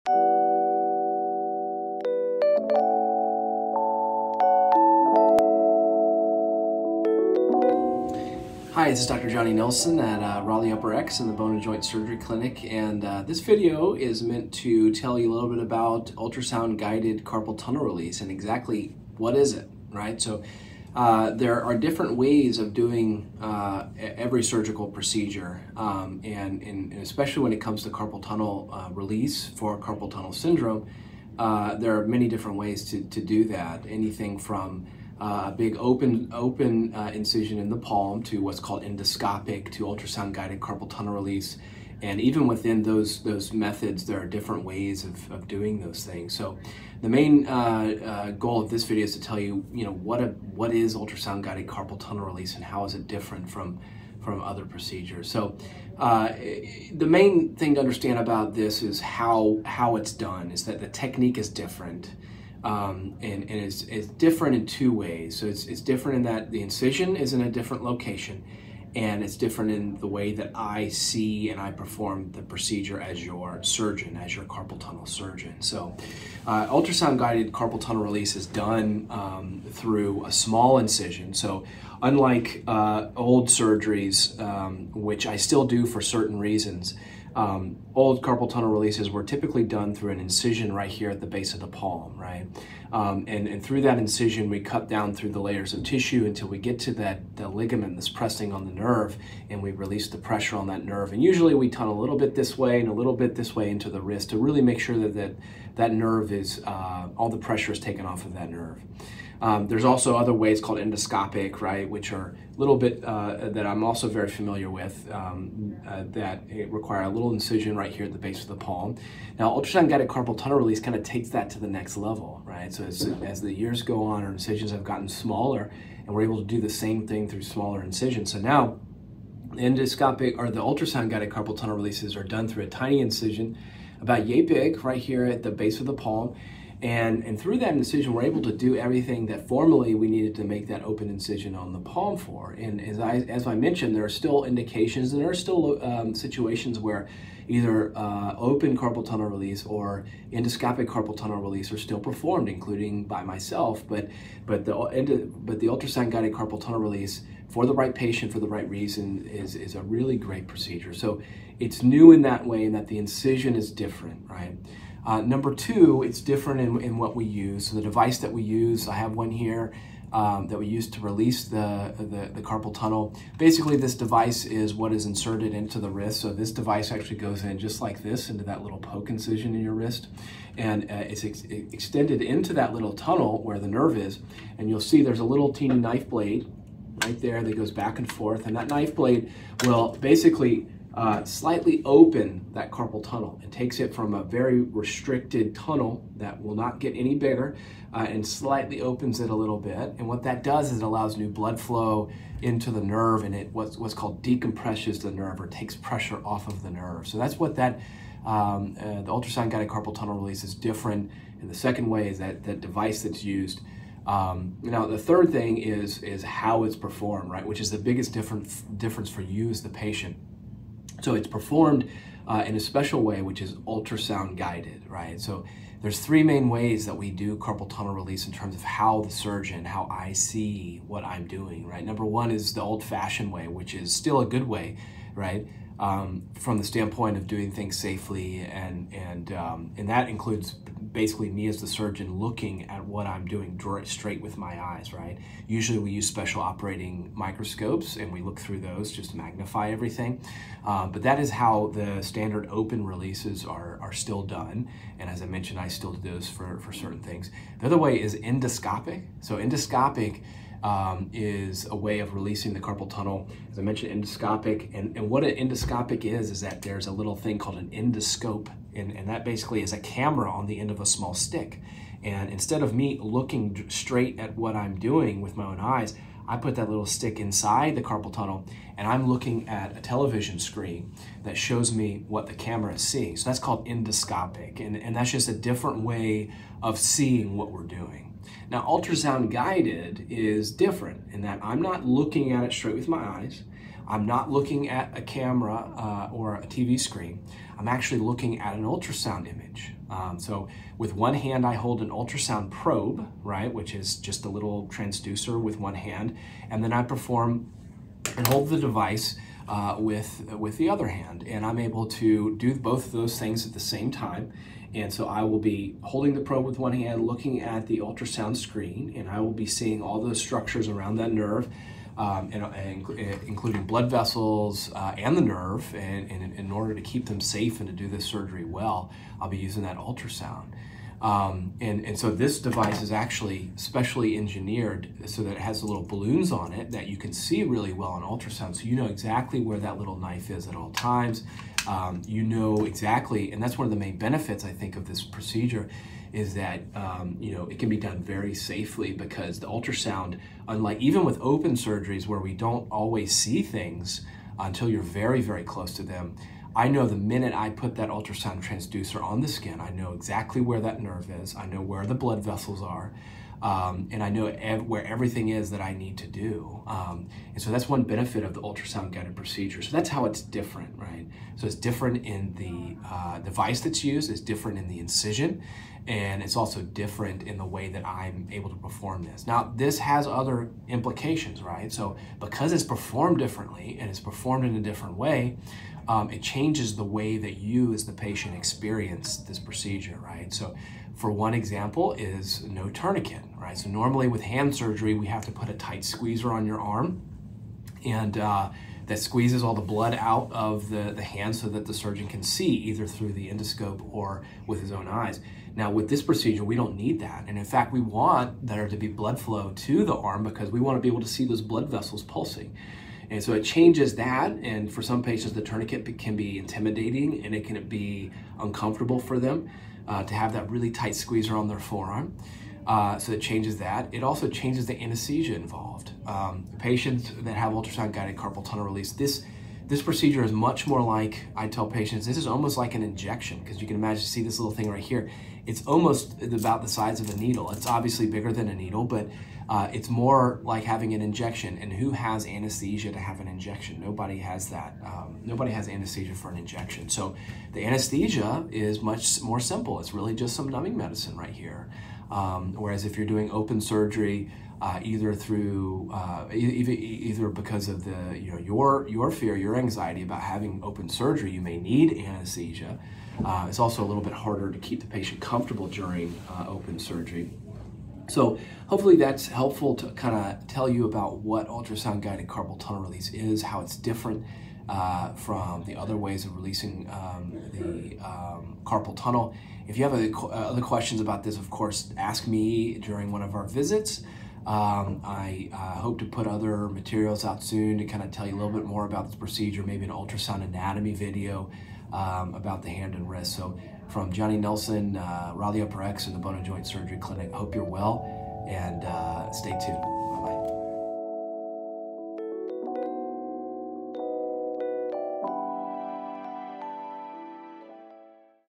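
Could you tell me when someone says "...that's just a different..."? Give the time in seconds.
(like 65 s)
284 s.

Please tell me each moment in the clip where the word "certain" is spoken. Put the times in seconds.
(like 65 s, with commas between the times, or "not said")
86 s, 256 s.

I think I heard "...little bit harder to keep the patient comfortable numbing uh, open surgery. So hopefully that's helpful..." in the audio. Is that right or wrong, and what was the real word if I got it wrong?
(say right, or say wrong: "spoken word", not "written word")
wrong: "during", not "numbing".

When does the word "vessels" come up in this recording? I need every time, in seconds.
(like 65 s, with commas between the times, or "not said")
323 s, 362 s, 411 s.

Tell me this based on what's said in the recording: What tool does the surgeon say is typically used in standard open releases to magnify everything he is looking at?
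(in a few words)
operating microscopes.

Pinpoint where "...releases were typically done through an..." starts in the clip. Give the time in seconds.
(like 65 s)
88 s.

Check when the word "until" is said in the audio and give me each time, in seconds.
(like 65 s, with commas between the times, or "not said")
96 s, 354 s.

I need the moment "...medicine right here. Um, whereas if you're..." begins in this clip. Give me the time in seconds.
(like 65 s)
450 s.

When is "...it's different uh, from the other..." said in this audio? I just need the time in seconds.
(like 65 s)
473 s.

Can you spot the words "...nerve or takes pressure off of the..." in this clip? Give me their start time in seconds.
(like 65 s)
205 s.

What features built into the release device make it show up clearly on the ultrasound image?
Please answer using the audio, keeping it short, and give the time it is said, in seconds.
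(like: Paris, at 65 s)
balloons, at 335 s.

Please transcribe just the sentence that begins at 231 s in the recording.
Number one is the old fashioned way, which is still a good way, right?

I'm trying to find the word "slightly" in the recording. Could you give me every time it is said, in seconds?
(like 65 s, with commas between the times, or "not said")
191 s, 198 s.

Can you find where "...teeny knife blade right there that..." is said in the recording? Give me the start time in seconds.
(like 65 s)
185 s.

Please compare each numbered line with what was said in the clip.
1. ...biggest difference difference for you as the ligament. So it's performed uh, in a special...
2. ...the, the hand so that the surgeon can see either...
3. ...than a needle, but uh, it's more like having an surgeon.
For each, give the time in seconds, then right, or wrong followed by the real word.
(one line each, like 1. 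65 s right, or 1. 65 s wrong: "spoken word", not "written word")
1. 217 s wrong: "patient", not "ligament"
2. 400 s right
3. 438 s wrong: "injection", not "surgeon".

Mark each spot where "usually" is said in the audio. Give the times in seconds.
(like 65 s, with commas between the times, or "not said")
101 s, 245 s.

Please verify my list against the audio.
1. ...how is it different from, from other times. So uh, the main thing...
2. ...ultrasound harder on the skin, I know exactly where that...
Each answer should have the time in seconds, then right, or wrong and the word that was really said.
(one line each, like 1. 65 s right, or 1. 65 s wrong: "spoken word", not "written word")
1. 52 s wrong: "procedures", not "times"
2. 357 s wrong: "transducer", not "harder".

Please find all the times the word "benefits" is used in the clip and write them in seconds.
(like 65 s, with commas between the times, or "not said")
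343 s, 367 s.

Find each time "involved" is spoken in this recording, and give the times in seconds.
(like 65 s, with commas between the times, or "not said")
425 s.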